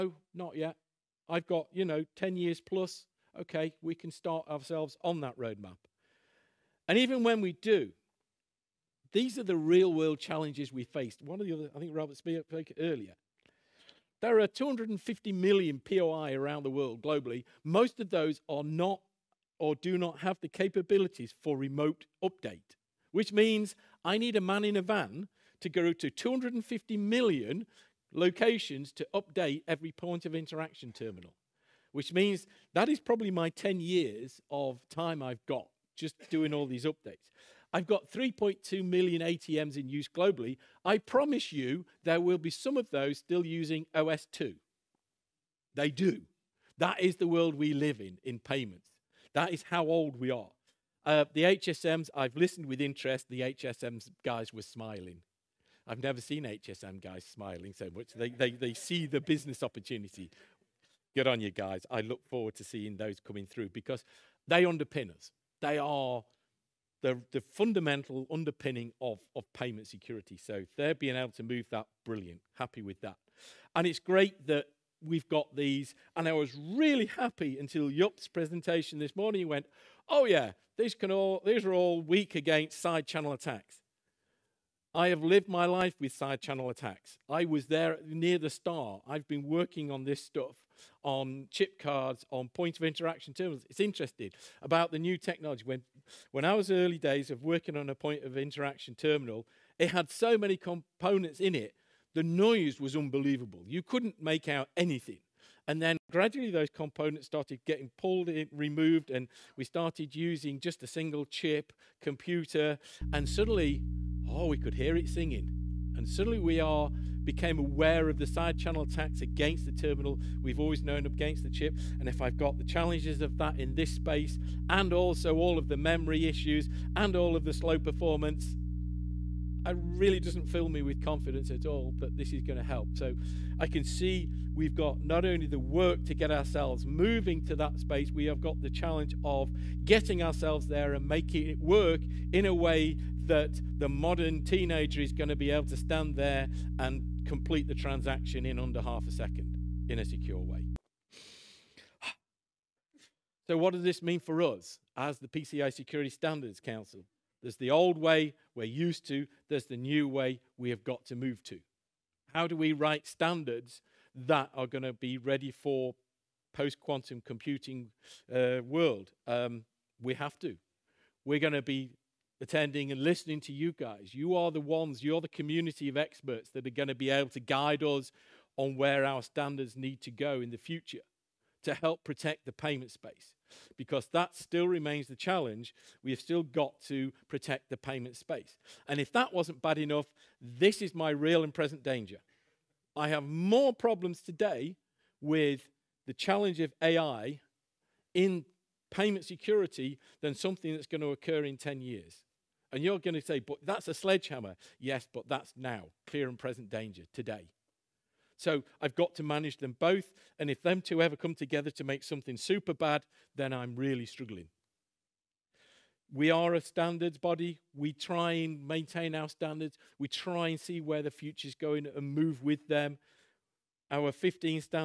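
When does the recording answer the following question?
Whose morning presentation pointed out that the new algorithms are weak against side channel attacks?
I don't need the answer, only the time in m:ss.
1:17.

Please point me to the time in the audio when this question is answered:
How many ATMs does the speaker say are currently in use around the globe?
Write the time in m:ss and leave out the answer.
0:38.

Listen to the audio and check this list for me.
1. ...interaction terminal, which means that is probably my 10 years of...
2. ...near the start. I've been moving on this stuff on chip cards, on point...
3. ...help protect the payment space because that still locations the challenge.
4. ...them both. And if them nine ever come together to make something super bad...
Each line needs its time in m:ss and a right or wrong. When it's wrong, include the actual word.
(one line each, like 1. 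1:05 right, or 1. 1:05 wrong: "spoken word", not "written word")
1. 0:30 right
2. 1:28 wrong: "working", not "moving"
3. 3:01 wrong: "remains", not "locations"
4. 3:29 wrong: "two", not "nine".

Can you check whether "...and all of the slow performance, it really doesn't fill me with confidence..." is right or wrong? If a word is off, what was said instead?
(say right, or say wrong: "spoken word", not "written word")
right.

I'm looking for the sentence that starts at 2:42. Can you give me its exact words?
How do we write standards that are going to be ready for post quantum computing uh, world?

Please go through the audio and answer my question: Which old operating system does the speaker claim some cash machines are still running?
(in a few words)
OS/2.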